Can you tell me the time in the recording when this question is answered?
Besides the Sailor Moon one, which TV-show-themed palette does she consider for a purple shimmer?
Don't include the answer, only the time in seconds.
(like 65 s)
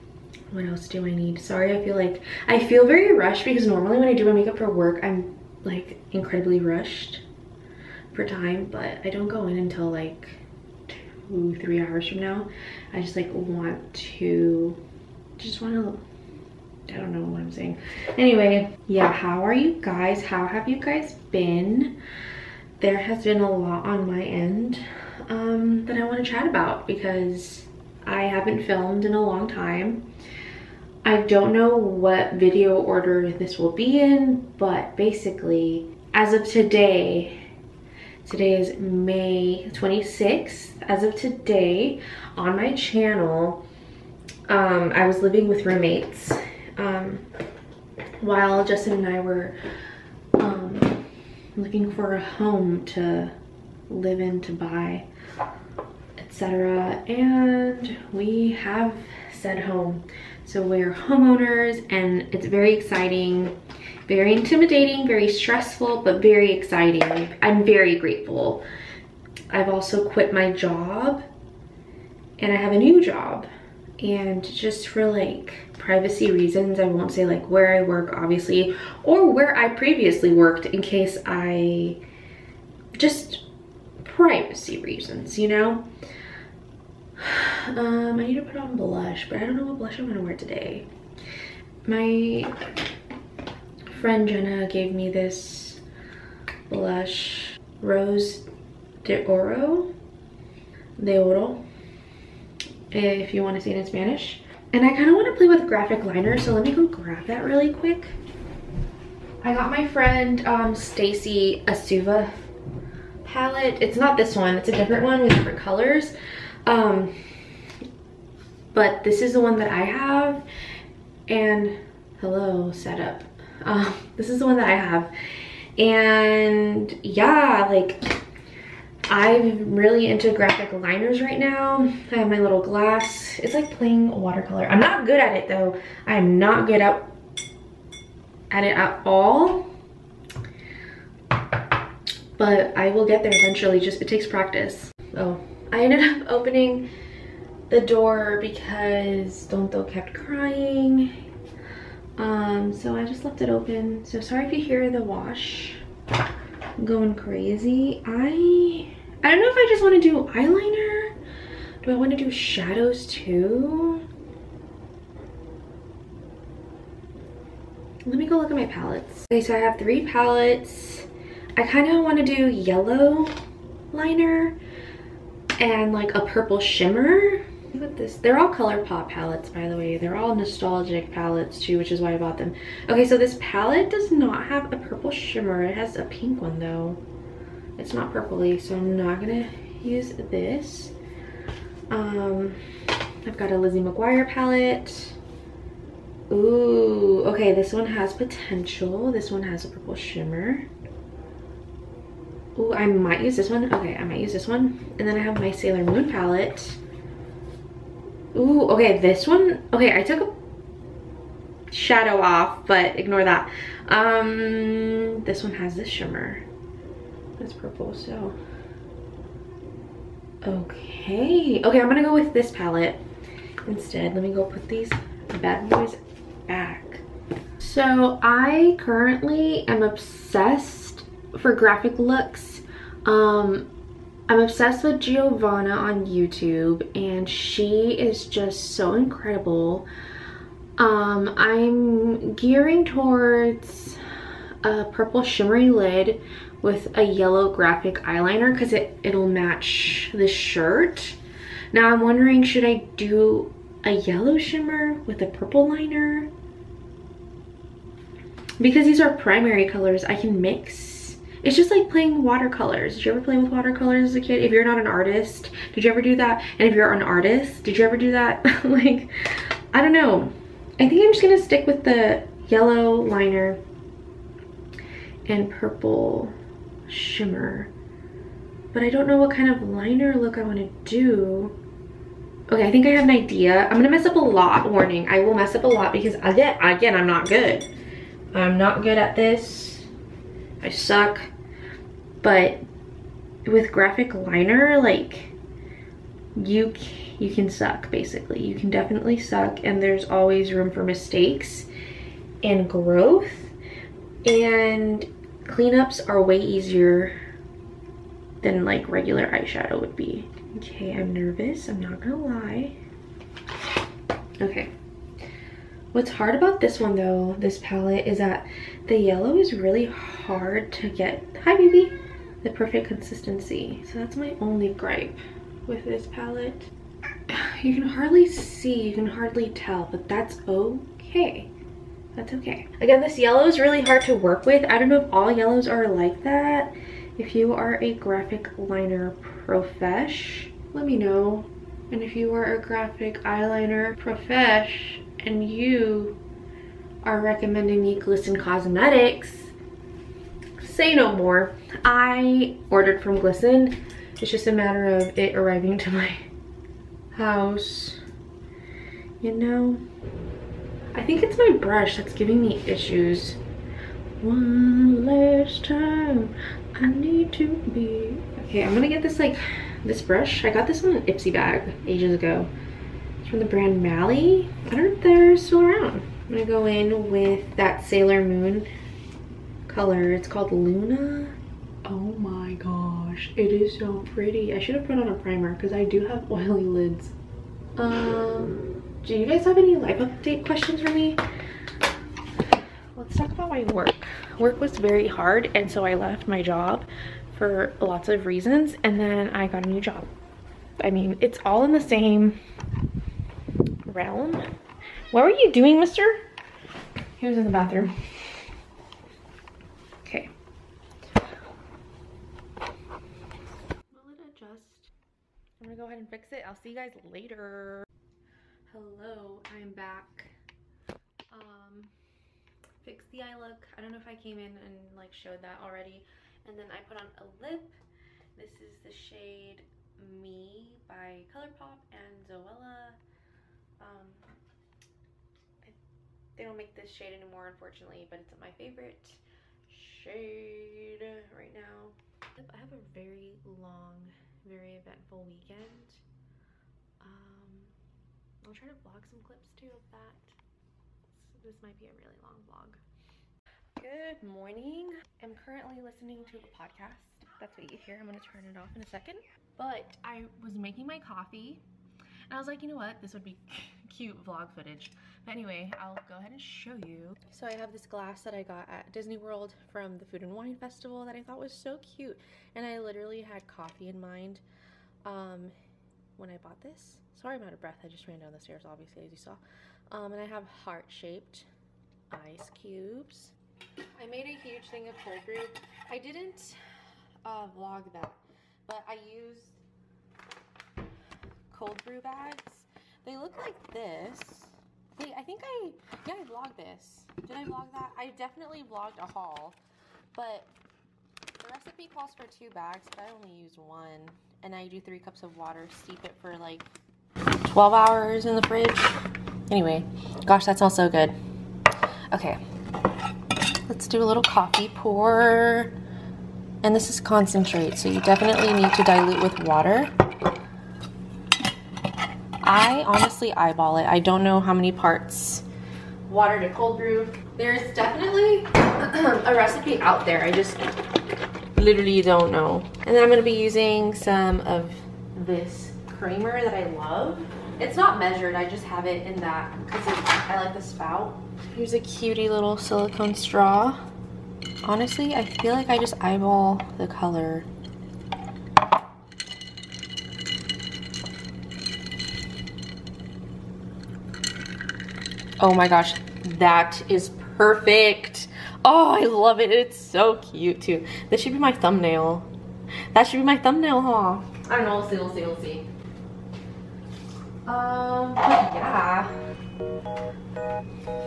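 193 s.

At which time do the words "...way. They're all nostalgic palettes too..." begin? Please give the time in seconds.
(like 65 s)
179 s.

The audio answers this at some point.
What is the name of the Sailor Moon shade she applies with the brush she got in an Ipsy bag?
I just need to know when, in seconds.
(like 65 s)
380 s.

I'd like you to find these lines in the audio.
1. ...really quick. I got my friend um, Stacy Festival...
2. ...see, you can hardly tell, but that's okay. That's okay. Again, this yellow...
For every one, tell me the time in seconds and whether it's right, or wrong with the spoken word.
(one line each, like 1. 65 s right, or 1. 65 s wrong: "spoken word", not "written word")
1. 107 s wrong: "Asuva", not "Festival"
2. 328 s right.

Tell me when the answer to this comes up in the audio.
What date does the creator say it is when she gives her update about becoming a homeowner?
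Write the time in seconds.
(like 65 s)
38 s.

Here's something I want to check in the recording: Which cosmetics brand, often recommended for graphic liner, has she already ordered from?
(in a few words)
Glisten Cosmetics.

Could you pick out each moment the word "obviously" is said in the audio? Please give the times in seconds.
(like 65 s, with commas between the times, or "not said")
78 s, 478 s.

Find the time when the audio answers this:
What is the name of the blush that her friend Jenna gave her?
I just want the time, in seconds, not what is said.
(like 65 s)
97 s.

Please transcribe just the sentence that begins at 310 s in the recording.
Okay, I'm nervous, I'm not gonna lie.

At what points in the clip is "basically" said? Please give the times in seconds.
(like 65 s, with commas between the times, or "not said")
34 s, 297 s.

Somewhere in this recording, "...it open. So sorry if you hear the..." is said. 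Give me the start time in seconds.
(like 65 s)
153 s.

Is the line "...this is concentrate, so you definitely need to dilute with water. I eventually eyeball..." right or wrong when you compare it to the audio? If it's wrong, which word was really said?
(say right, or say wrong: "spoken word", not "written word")
wrong: "honestly", not "eventually".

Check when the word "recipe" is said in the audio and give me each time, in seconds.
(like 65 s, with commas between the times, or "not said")
501 s, 529 s.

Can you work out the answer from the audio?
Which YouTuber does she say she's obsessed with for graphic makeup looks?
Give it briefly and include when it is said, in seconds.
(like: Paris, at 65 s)
Giovanna, at 234 s.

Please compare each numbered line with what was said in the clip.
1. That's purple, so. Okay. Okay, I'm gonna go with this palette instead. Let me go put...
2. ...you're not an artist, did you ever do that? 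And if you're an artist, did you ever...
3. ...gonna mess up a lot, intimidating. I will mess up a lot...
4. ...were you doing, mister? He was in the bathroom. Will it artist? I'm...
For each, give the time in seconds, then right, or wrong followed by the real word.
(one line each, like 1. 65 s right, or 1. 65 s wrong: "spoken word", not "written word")
1. 217 s right
2. 264 s right
3. 283 s wrong: "warning", not "intimidating"
4. 405 s wrong: "adjust", not "artist".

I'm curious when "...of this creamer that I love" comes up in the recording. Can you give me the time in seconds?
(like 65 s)
534 s.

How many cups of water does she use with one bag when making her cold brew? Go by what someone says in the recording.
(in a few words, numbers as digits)
3.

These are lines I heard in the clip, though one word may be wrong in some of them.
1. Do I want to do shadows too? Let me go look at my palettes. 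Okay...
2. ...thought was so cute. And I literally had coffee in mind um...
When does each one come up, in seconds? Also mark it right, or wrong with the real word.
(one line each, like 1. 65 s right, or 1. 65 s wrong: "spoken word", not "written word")
1. 161 s right
2. 471 s right.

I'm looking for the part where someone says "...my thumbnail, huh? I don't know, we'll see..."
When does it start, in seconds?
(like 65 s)
563 s.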